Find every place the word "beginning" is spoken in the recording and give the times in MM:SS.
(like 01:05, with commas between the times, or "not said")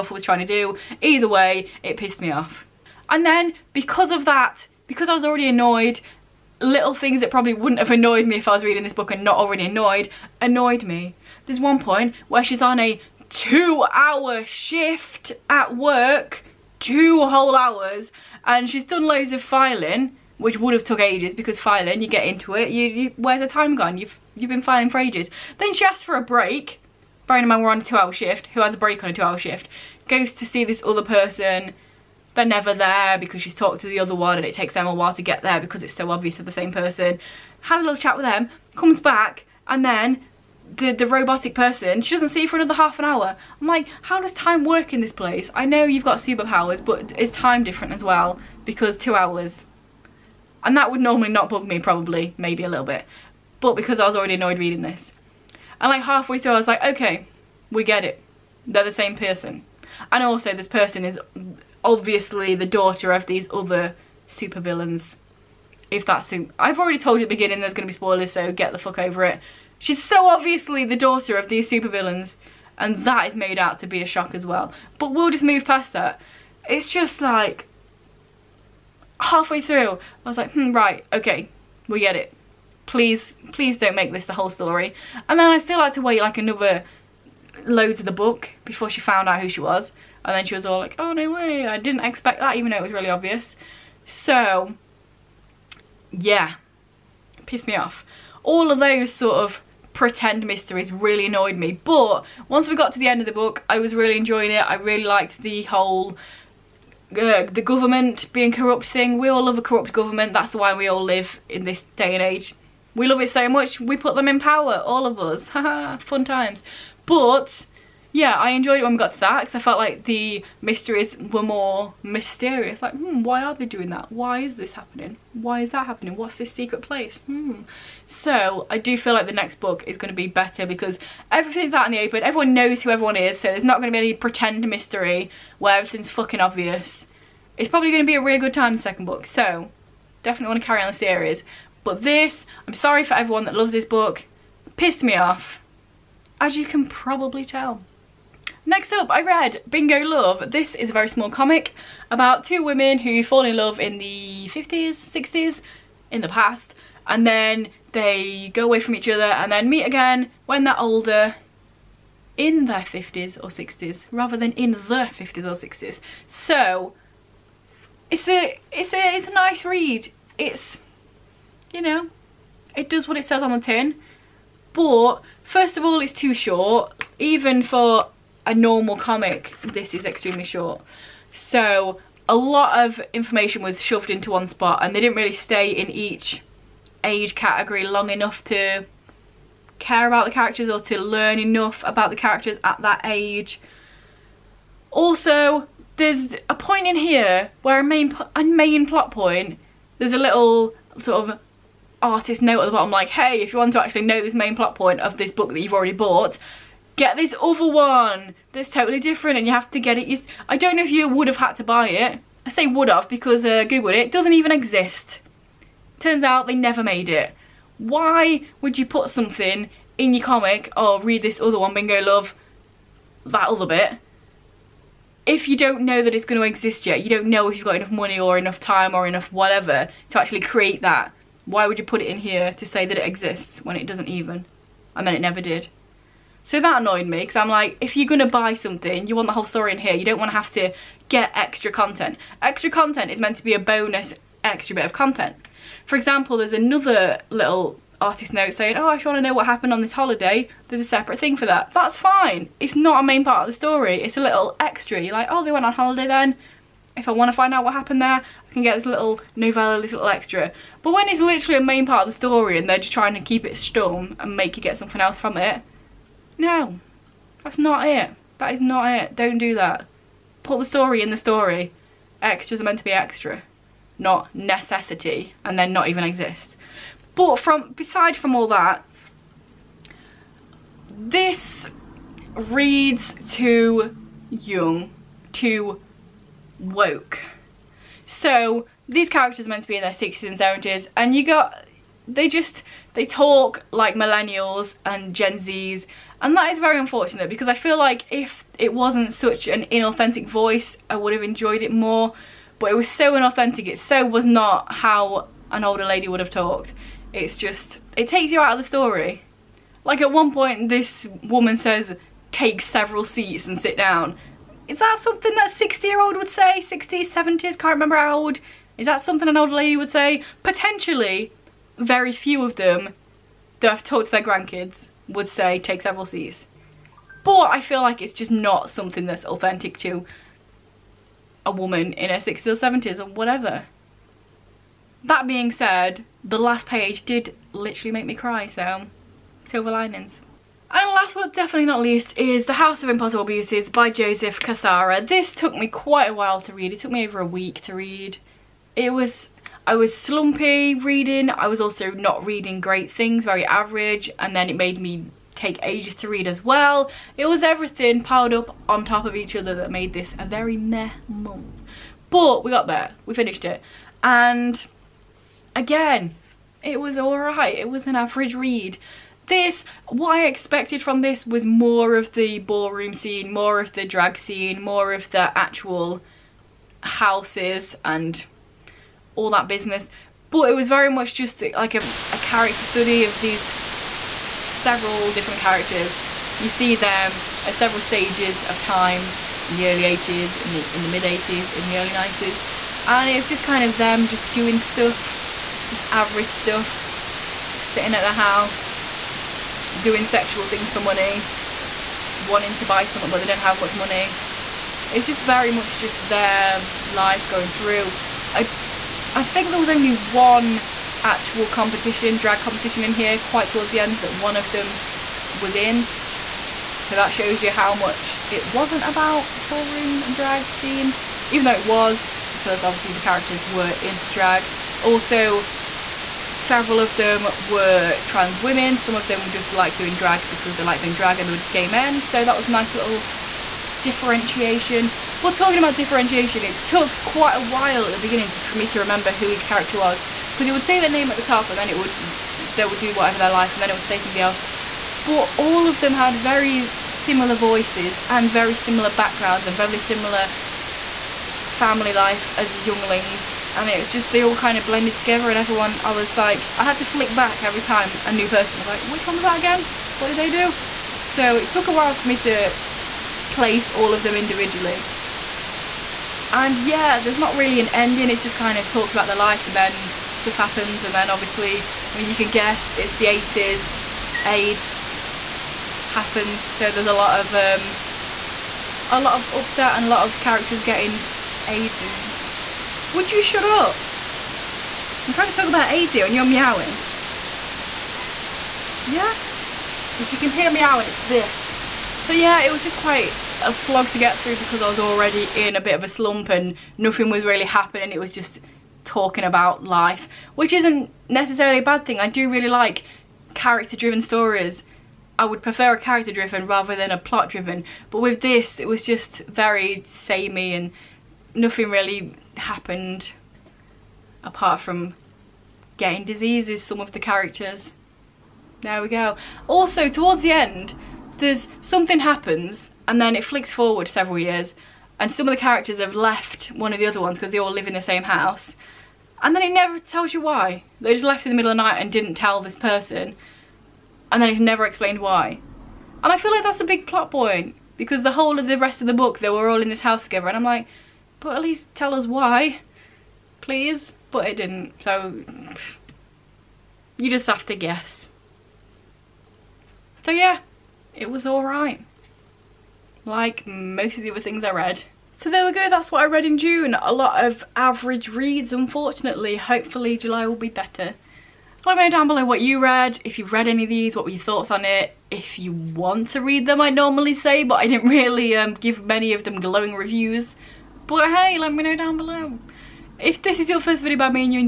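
01:07, 07:17.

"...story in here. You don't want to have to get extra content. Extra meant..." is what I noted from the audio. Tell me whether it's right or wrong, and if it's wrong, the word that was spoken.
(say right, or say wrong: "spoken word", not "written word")
wrong: "content", not "meant".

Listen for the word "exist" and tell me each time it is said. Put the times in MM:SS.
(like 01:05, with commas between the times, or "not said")
03:34, 03:46, 03:53, 04:36.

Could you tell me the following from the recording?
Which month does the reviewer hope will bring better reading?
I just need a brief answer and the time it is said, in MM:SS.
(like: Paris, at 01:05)
July, at 09:19.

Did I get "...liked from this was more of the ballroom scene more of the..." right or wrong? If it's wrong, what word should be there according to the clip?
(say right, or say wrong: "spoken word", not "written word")
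wrong: "expected", not "liked".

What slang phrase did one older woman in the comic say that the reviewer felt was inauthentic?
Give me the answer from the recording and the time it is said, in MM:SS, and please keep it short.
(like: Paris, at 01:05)
Take several seats, at 05:12.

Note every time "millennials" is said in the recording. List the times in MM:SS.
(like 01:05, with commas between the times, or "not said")
04:53.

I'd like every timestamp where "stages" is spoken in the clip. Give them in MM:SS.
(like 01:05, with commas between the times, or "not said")
06:27.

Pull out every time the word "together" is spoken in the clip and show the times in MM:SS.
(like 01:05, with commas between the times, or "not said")
07:34, 09:00.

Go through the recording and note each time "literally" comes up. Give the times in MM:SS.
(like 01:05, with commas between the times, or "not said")
04:21, 05:37.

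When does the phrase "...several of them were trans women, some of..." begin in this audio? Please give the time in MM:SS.
07:06.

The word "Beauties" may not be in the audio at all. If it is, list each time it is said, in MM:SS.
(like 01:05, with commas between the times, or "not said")
05:43.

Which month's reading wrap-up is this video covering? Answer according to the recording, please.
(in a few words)
June.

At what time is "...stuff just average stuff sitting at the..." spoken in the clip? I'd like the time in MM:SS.
06:34.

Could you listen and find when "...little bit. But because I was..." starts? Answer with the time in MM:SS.
00:52.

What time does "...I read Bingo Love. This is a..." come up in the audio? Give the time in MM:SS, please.
02:29.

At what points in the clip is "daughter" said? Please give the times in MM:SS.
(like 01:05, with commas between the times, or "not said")
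01:02, 01:10.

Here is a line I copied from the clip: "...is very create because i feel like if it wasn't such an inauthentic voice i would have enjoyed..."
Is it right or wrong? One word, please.
wrong.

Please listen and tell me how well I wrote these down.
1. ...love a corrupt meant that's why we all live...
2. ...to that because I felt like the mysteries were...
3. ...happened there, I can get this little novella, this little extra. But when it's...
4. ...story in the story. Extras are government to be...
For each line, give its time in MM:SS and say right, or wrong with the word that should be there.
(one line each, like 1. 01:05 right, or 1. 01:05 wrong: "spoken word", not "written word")
1. 01:49 wrong: "government", not "meant"
2. 01:59 right
3. 04:17 right
4. 04:30 wrong: "meant", not "government".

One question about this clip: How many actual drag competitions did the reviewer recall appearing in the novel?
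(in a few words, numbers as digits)
1.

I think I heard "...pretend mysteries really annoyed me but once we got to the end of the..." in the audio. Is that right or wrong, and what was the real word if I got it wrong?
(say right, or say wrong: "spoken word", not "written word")
right.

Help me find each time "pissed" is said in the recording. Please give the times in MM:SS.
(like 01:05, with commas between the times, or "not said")
00:01, 01:37, 02:24.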